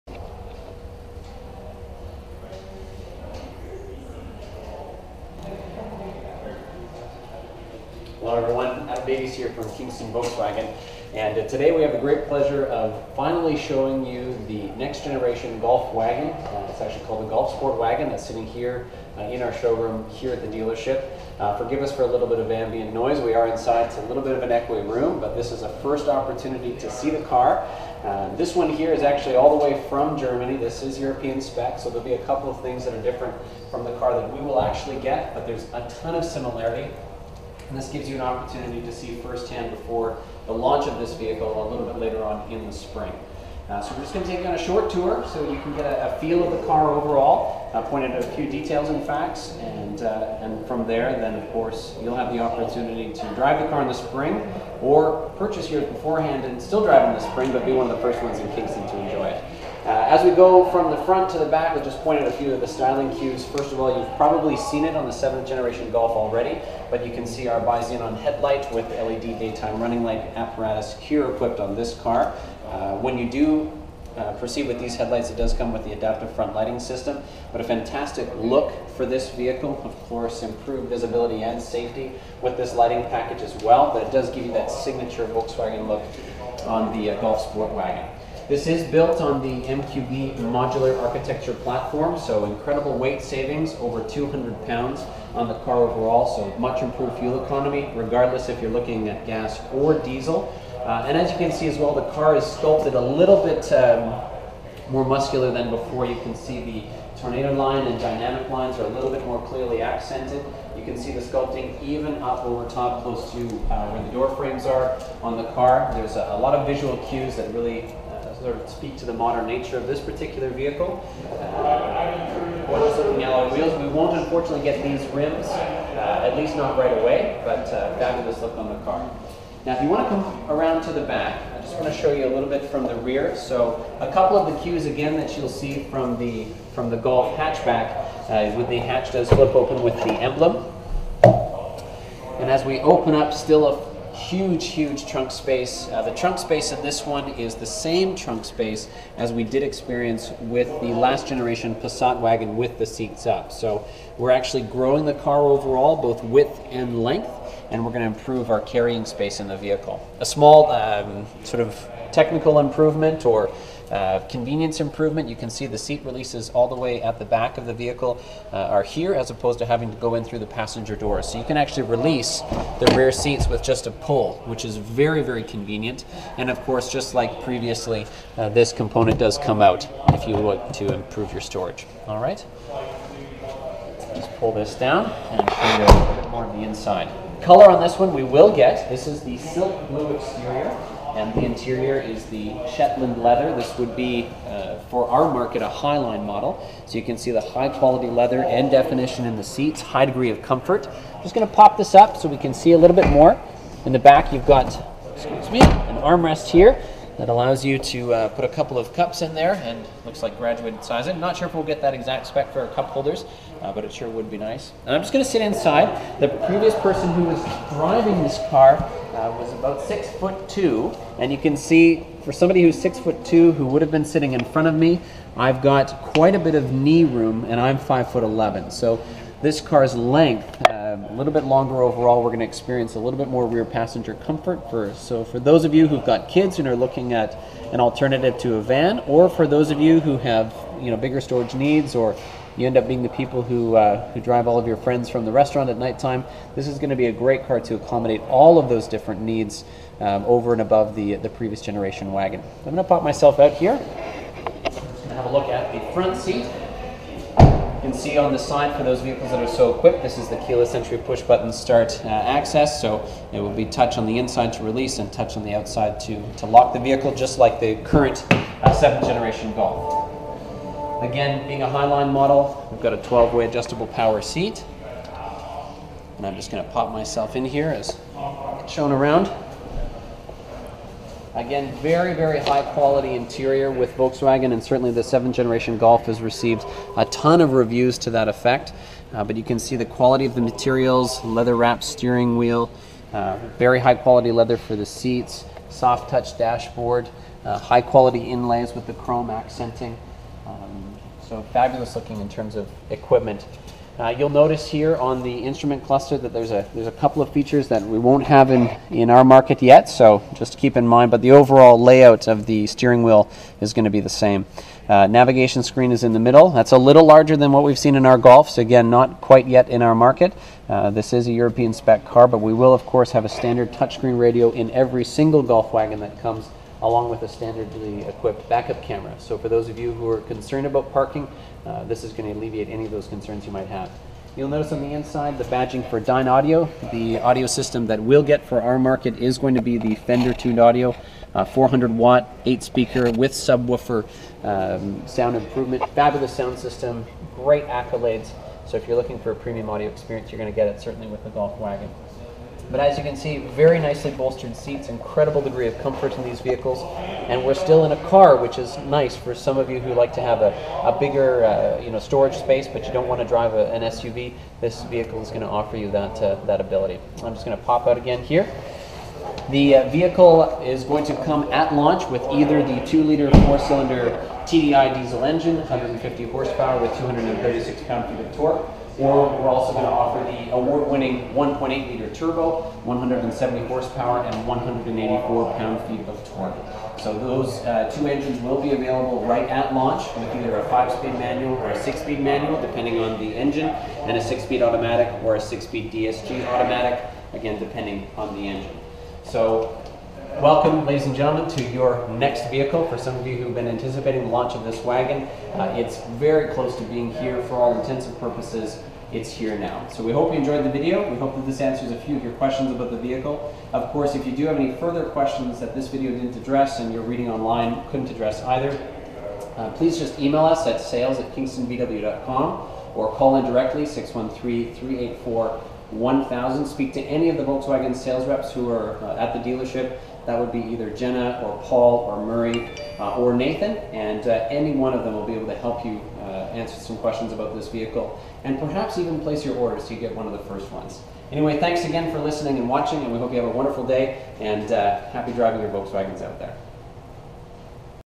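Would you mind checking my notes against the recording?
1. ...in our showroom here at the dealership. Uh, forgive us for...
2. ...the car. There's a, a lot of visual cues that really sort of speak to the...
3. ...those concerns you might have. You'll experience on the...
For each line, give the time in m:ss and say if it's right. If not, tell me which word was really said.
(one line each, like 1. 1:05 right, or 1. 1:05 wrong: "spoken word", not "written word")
1. 0:19 right
2. 1:55 right
3. 5:32 wrong: "notice", not "experience".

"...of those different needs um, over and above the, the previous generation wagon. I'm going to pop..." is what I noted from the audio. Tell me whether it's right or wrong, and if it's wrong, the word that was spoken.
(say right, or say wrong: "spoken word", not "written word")
right.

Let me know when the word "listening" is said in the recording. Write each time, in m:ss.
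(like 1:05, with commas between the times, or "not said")
7:22.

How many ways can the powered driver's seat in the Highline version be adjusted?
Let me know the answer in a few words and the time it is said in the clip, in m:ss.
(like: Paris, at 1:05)
12, at 4:32.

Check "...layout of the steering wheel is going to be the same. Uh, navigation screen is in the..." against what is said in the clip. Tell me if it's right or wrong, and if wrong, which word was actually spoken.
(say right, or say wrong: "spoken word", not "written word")
right.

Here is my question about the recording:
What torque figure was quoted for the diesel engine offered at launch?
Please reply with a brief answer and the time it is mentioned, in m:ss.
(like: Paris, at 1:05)
236 pound-feet, at 6:16.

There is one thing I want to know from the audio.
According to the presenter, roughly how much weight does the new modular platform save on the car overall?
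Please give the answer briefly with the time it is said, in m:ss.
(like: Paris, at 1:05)
over 200 pounds, at 1:33.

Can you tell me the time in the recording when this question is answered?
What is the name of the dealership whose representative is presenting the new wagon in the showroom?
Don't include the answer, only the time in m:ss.
0:09.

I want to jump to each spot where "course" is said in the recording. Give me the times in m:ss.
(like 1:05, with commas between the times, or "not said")
0:51, 1:20, 2:56, 5:22, 6:53.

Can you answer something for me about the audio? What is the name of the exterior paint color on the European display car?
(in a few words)
silk blue.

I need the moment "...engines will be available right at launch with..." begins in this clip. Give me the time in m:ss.
6:28.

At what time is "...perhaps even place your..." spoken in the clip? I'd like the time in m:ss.
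7:18.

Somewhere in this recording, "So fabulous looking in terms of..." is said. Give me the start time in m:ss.
5:01.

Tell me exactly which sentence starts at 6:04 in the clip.
This vehicle is going to offer you that, uh, that ability.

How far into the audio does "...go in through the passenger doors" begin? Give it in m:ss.
2:49.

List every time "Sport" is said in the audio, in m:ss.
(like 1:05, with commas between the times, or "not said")
0:17, 1:27.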